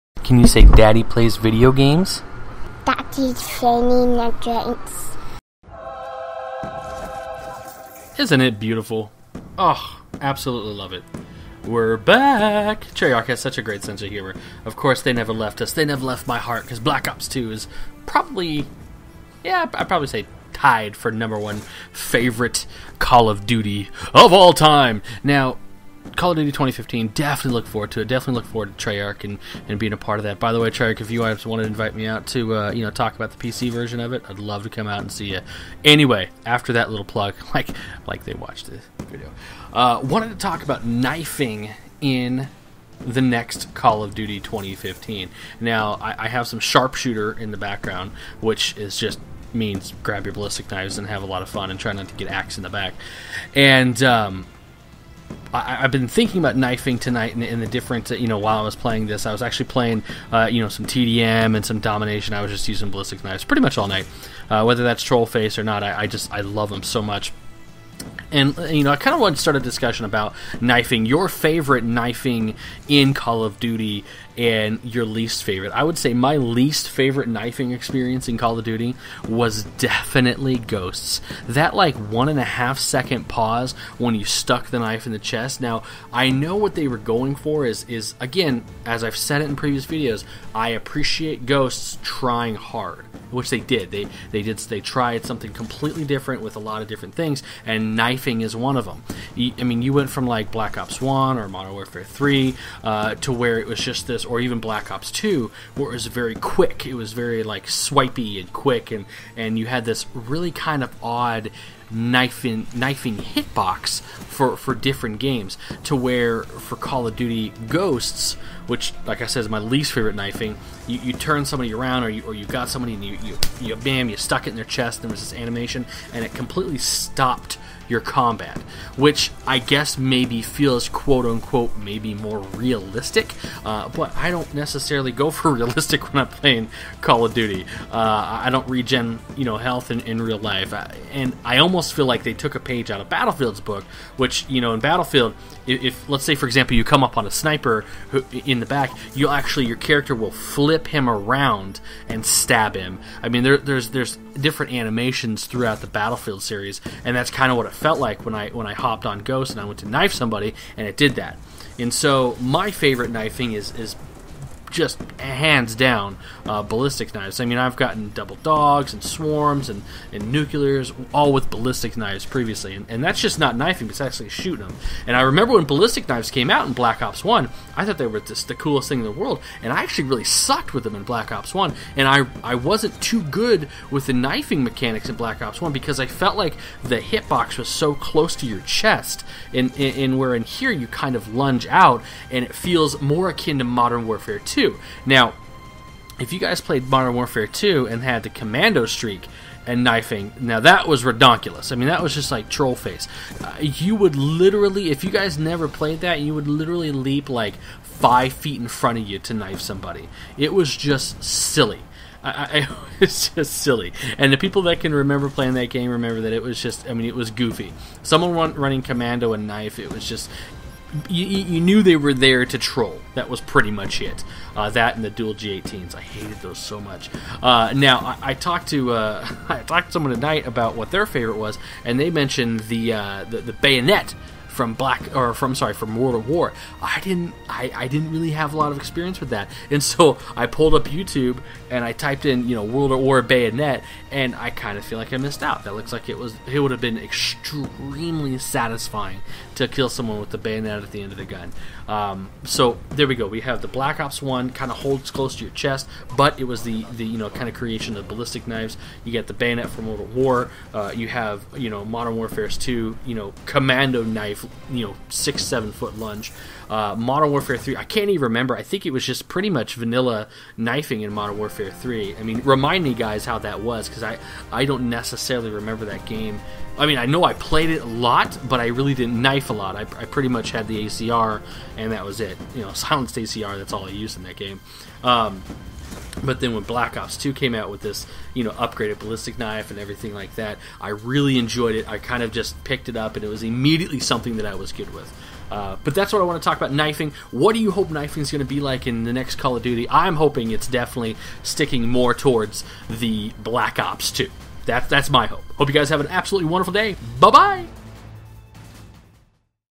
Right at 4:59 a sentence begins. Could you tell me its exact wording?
I'm hoping it's definitely sticking more towards the Black Ops 2.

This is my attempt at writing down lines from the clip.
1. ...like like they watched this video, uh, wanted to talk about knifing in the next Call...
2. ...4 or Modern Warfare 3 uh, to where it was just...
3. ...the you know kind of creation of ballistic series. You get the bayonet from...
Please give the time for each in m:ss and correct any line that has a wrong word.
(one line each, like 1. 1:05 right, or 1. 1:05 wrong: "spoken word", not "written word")
1. 0:37 right
2. 1:41 wrong: "1", not "4"
3. 4:16 wrong: "knives", not "series".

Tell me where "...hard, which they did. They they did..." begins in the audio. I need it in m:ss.
1:32.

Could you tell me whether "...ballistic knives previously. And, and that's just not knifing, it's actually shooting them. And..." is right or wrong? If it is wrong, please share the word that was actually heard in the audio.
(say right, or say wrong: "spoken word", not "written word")
right.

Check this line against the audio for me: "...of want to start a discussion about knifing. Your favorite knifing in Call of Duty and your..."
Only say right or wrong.
right.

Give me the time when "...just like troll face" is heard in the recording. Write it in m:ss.
3:22.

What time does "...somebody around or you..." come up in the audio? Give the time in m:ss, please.
2:01.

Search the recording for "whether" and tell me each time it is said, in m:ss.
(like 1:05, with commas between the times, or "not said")
1:04.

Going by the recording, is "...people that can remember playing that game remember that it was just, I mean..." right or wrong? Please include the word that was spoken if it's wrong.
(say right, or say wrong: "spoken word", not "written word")
right.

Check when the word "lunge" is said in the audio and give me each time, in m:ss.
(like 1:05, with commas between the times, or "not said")
3:11, 4:25.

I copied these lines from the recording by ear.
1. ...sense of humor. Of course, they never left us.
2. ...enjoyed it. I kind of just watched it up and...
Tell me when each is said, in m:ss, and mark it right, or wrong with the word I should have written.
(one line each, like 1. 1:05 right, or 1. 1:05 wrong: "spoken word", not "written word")
1. 0:13 right
2. 4:51 wrong: "picked", not "watched".